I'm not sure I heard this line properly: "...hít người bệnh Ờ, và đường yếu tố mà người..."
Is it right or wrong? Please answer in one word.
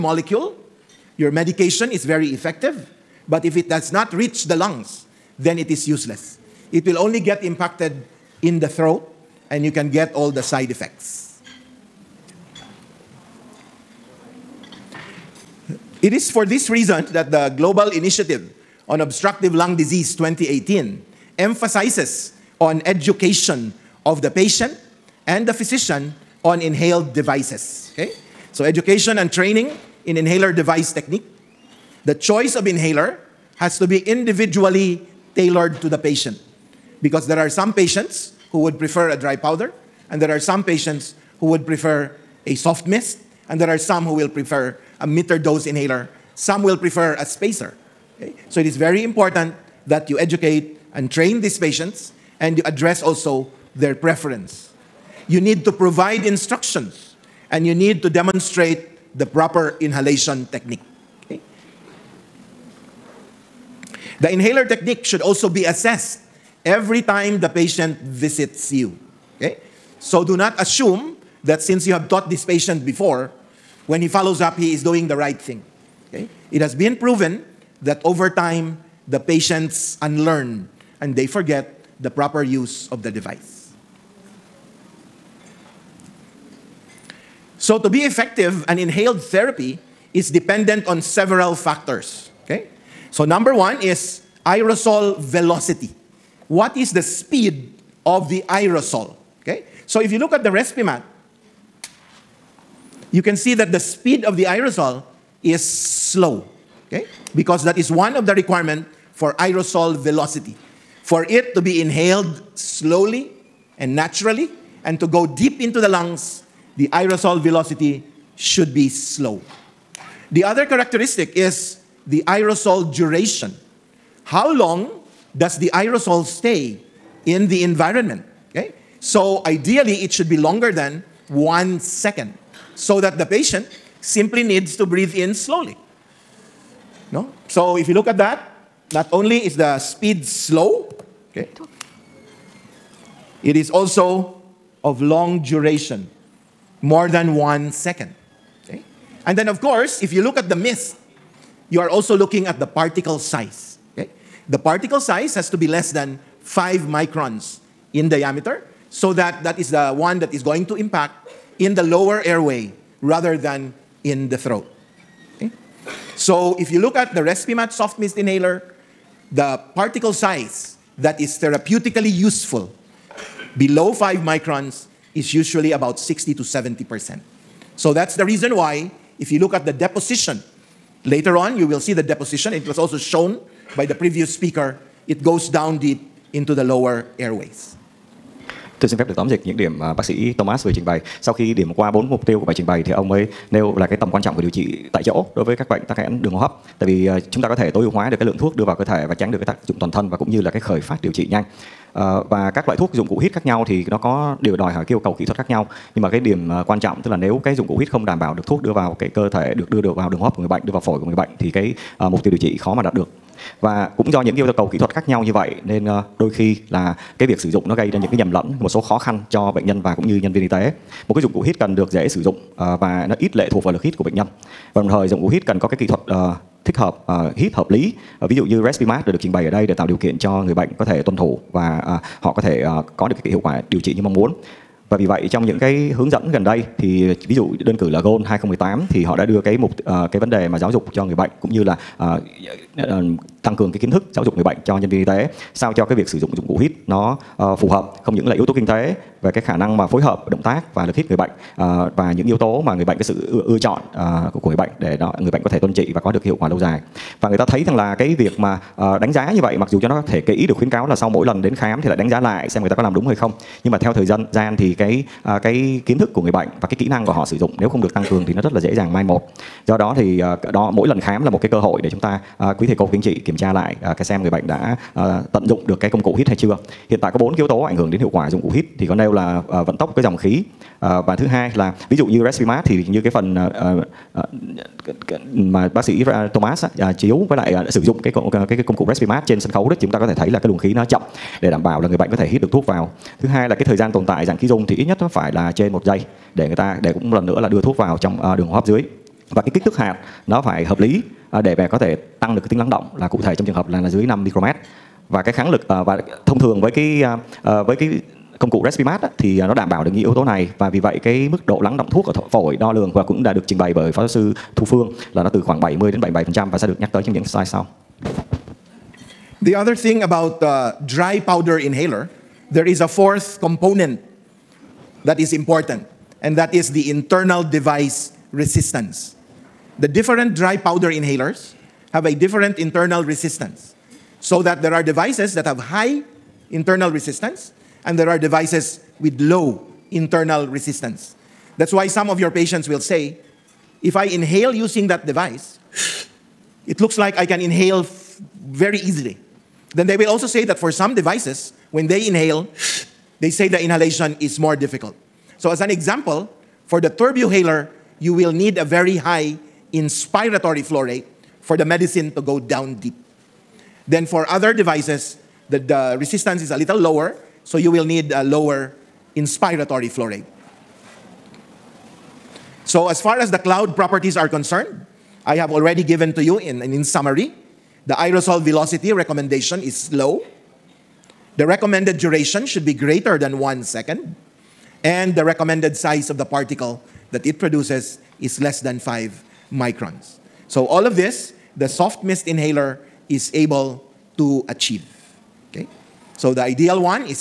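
wrong.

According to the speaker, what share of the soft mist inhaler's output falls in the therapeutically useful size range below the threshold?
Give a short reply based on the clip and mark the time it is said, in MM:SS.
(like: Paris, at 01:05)
60 to 70 percent, at 02:55.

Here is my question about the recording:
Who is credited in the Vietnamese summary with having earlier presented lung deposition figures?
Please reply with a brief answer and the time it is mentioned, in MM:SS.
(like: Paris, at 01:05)
Thu Phương, at 05:14.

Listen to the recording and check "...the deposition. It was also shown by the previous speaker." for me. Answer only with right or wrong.
right.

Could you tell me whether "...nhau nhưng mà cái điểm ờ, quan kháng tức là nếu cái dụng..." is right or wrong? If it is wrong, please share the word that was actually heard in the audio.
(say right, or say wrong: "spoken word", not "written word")
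wrong: "trọng", not "kháng".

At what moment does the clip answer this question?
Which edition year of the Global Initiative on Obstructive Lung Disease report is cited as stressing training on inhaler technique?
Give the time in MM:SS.
00:17.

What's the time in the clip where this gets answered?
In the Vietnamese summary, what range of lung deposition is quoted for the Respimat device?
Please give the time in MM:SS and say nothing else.
05:15.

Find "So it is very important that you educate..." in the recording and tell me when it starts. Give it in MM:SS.
00:48.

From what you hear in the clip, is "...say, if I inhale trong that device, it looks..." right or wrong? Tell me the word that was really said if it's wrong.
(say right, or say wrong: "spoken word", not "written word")
wrong: "using", not "trong".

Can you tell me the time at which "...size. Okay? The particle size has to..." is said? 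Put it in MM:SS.
02:33.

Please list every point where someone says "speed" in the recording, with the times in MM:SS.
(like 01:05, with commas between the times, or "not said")
01:37, 01:43, 02:19.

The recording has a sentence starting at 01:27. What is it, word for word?
So, to be effective, an inhaled therapy is dependent on several factors.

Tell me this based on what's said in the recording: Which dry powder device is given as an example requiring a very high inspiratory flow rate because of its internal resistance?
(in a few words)
Turbuhaler.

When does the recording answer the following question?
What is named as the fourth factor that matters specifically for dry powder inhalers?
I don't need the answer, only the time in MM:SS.
05:26.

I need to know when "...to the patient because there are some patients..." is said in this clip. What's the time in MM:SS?
00:35.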